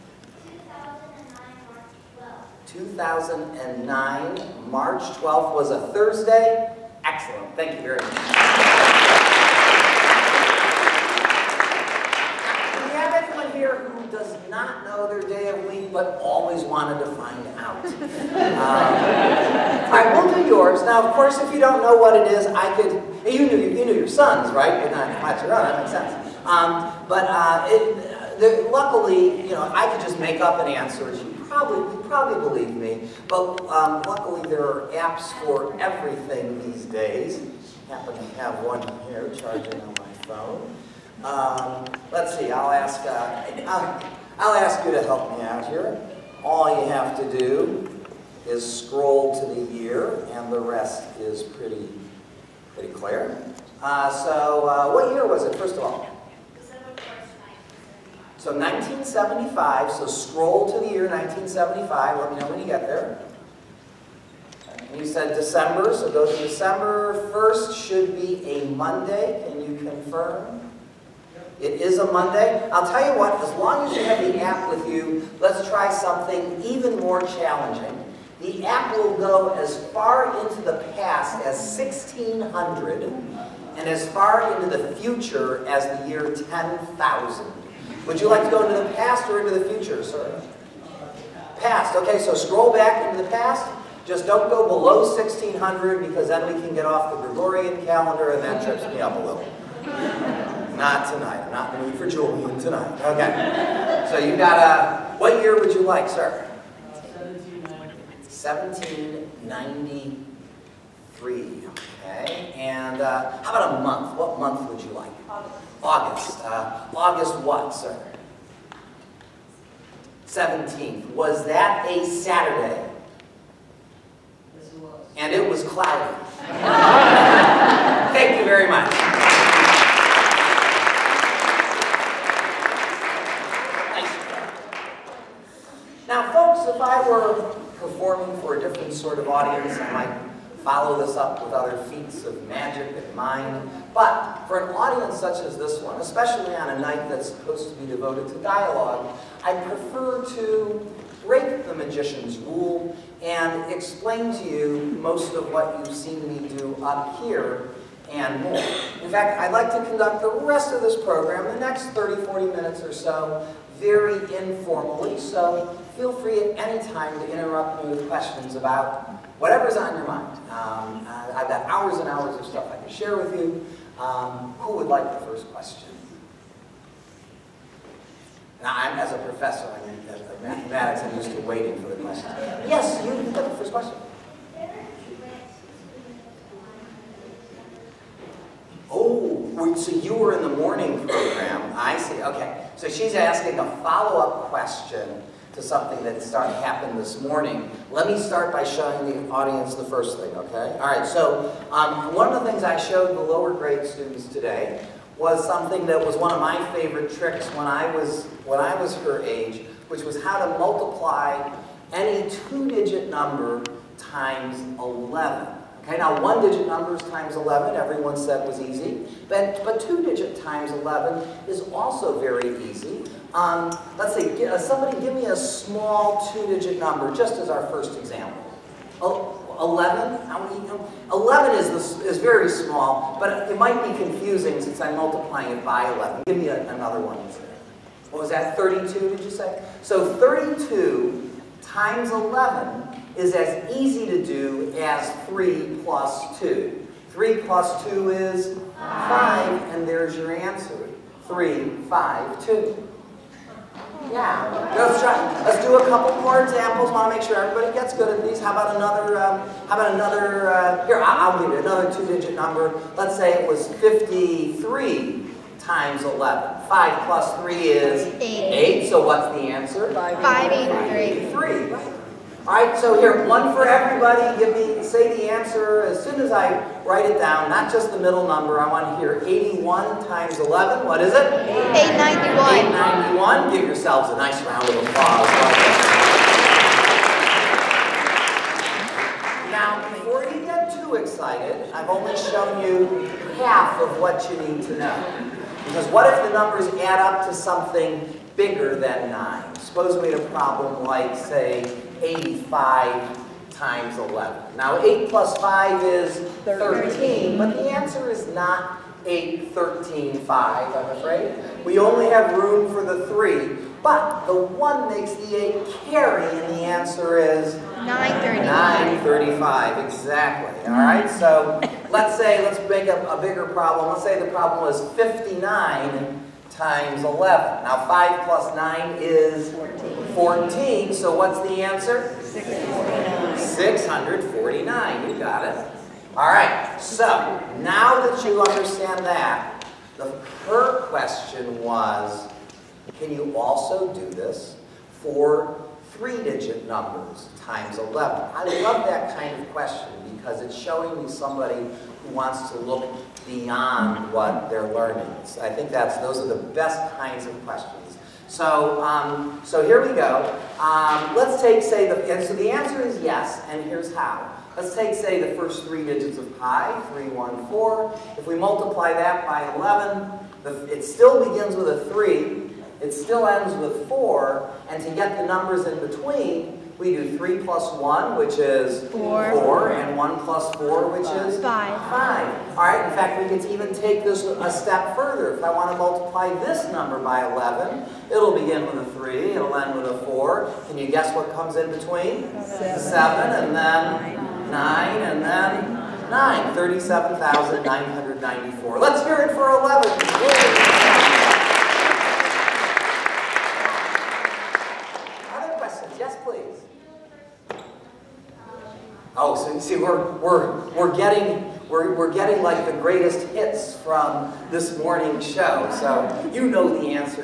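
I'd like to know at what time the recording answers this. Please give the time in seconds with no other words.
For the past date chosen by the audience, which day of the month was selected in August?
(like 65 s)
120 s.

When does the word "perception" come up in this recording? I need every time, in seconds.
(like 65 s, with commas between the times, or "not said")
not said.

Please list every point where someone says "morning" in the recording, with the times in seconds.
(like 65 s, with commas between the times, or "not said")
190 s, 197 s, 414 s.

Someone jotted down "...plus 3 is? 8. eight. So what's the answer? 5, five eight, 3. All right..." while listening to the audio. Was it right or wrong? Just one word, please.
right.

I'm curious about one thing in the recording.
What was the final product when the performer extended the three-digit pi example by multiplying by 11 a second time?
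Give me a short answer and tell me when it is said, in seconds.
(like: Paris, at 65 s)
37,994, at 396 s.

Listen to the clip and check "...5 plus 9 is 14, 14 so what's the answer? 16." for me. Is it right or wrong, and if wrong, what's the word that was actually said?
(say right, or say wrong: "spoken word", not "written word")
right.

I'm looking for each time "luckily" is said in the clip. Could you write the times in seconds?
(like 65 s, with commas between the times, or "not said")
28 s, 34 s.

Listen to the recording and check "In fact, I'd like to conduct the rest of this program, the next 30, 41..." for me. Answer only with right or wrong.
wrong.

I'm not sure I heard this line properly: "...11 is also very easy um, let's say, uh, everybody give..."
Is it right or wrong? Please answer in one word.
wrong.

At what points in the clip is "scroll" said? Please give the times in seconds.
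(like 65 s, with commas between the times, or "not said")
48 s, 60 s, 92 s.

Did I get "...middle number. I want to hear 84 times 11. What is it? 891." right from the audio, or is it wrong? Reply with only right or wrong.
wrong.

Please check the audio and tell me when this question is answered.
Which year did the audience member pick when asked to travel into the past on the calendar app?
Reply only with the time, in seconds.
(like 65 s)
106 s.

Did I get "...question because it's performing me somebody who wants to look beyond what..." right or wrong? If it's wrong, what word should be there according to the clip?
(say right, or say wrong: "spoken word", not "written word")
wrong: "showing", not "performing".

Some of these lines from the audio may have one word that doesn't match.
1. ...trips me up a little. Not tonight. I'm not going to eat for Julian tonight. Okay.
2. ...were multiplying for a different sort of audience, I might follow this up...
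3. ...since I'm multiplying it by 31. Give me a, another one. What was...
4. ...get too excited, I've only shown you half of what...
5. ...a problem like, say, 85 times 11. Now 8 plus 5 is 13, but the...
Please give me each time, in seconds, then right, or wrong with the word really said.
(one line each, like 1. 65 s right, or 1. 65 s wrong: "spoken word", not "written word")
1. 98 s right
2. 137 s wrong: "performing", not "multiplying"
3. 234 s wrong: "11", not "31"
4. 290 s right
5. 300 s right.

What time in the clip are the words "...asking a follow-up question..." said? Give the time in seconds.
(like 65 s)
193 s.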